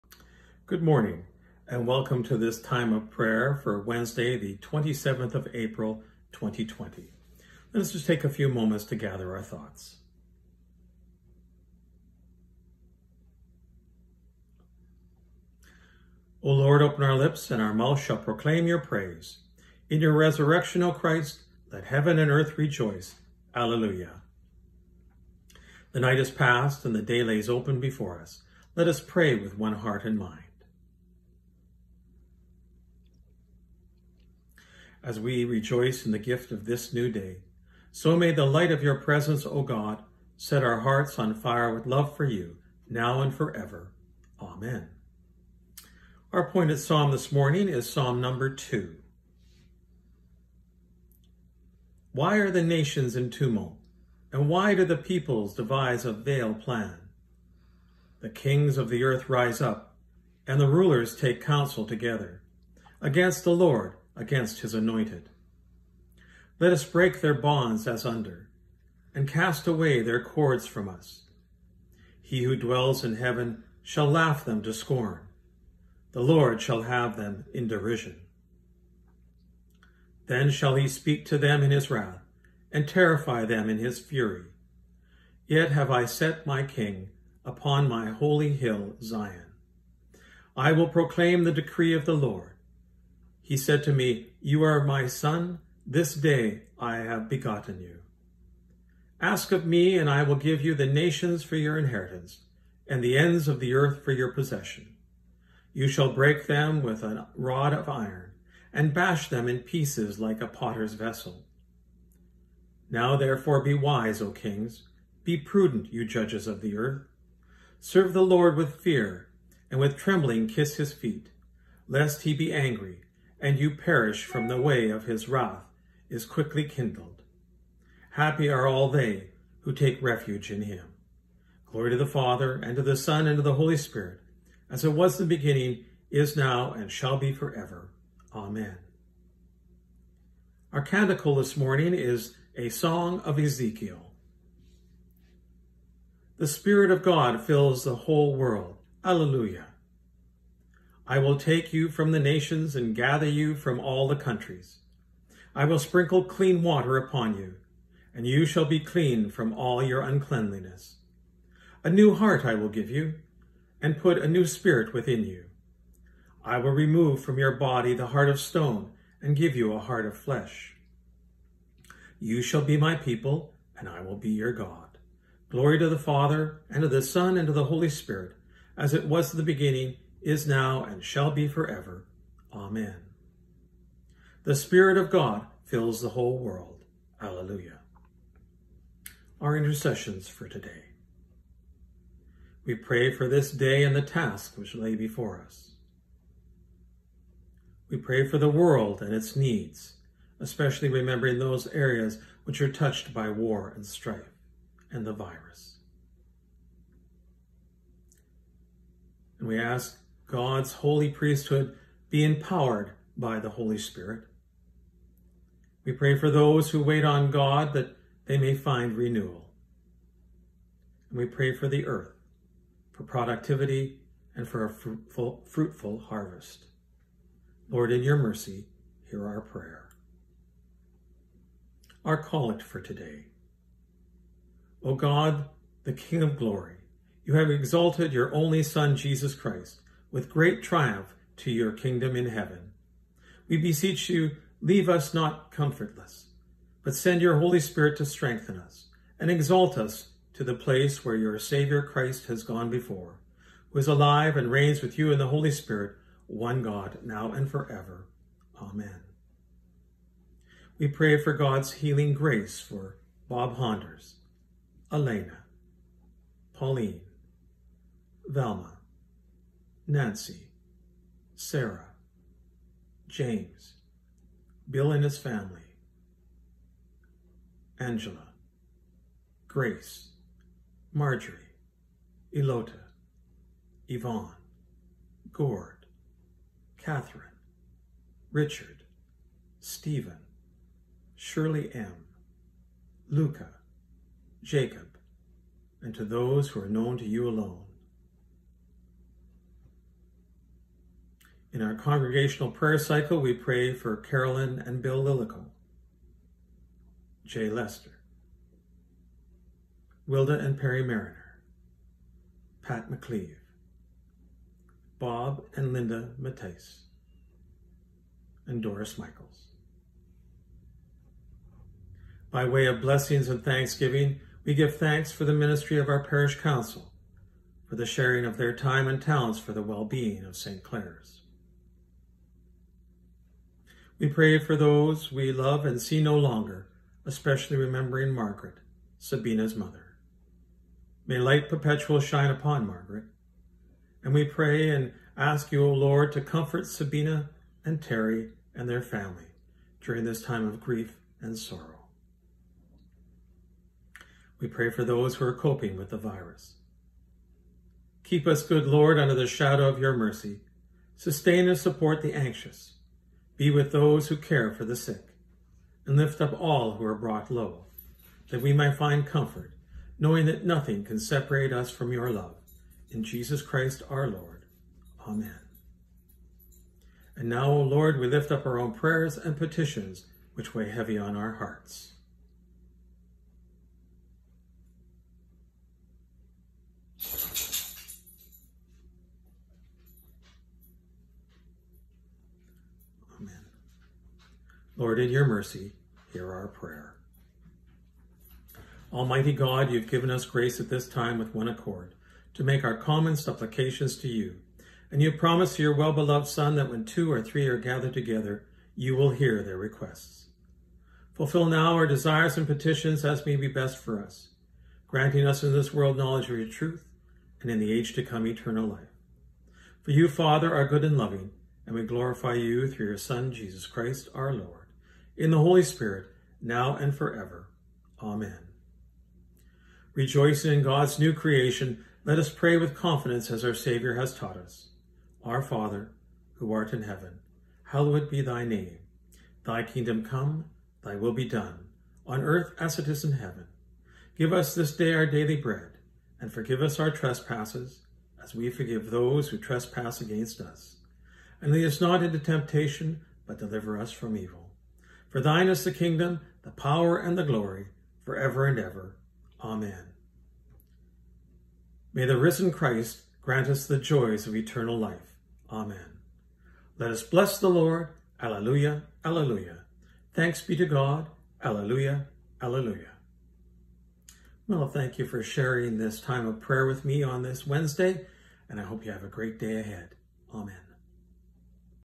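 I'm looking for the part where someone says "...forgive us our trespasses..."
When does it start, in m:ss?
7:26.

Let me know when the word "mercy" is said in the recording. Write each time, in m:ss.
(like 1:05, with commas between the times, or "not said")
3:48, 5:59, 6:35.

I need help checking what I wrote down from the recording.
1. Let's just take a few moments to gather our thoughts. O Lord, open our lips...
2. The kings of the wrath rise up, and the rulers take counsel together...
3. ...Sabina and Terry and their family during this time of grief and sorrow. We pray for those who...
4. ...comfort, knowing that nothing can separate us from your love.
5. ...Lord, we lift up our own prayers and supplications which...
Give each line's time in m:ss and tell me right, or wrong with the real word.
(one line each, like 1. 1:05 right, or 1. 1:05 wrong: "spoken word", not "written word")
1. 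0:07 right
2. 0:58 wrong: "earth", not "wrath"
3. 5:46 right
4. 6:09 right
5. 6:17 wrong: "petitions", not "supplications".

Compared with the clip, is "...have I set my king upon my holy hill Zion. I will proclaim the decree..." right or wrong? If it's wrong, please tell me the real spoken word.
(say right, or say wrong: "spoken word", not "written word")
right.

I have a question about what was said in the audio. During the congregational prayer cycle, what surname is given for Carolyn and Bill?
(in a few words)
Lillico.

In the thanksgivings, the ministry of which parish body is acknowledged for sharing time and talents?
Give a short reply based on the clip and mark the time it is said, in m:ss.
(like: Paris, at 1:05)
parish council, at 5:26.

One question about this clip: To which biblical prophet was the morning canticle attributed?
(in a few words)
Ezekiel.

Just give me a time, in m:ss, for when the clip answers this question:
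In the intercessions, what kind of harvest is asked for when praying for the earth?
3:45.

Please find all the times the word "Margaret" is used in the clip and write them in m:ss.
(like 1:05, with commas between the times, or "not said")
5:38, 5:42.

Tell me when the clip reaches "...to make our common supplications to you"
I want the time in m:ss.
6:42.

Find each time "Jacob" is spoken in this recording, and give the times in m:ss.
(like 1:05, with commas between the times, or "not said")
4:54.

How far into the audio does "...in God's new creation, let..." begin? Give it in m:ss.
7:10.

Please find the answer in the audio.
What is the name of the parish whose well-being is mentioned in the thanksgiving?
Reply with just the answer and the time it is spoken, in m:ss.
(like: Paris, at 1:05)
St. Clare's, at 5:30.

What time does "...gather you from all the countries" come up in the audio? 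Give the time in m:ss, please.
2:32.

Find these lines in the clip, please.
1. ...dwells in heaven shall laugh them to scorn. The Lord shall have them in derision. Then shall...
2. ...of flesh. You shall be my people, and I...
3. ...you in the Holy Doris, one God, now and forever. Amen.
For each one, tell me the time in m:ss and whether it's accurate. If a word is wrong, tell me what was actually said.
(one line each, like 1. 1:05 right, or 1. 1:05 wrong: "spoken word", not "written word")
1. 1:12 right
2. 2:50 right
3. 4:14 wrong: "Spirit", not "Doris".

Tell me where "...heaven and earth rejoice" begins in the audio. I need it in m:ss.
0:21.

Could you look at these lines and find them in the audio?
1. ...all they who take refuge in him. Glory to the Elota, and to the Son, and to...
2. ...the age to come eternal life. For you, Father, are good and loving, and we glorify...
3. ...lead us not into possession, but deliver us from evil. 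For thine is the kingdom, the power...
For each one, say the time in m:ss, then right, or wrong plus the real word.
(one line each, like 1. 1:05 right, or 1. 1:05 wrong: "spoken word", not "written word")
1. 2:08 wrong: "Father", not "Elota"
2. 6:57 right
3. 7:31 wrong: "temptation", not "possession".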